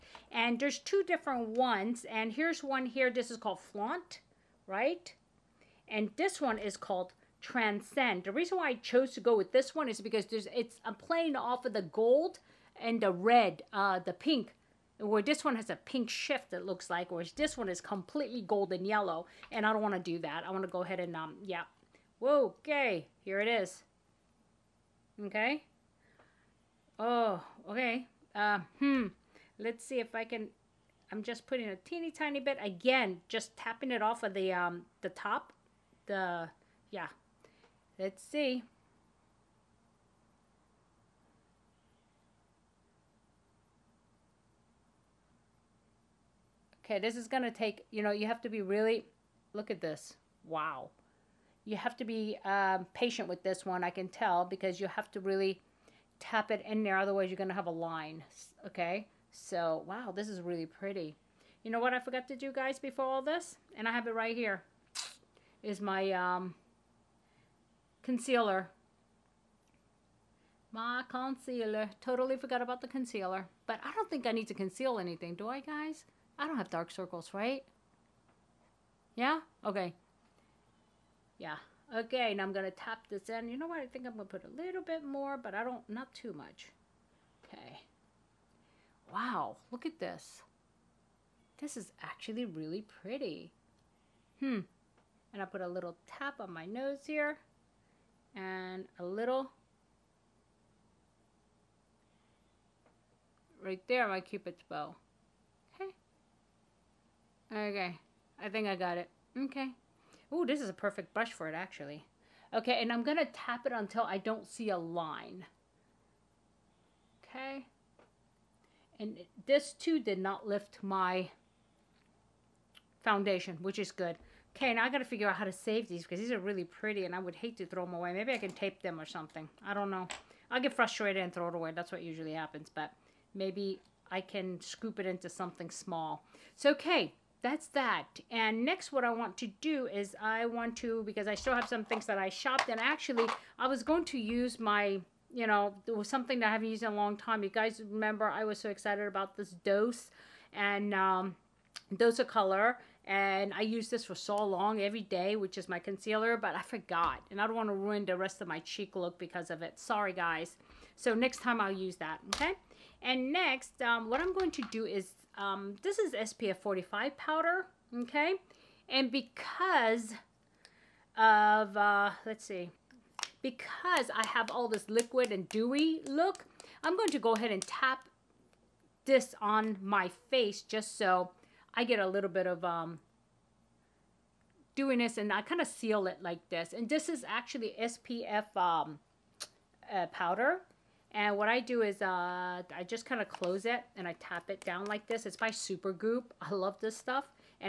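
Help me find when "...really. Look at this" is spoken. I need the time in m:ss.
0:48.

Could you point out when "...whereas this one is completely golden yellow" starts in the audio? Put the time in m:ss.
0:17.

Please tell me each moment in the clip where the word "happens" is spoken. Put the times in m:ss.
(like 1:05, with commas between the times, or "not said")
2:12.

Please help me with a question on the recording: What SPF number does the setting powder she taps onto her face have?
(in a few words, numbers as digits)
45.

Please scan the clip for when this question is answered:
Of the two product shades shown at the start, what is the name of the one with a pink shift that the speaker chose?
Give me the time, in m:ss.
0:03.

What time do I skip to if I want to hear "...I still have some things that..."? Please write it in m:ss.
2:21.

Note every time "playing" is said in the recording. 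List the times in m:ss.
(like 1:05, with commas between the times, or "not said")
0:10.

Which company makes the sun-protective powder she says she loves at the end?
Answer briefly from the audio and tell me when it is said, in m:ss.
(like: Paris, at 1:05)
Supergoop, at 3:15.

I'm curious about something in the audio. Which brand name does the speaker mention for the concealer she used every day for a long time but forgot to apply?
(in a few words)
Dose of Color.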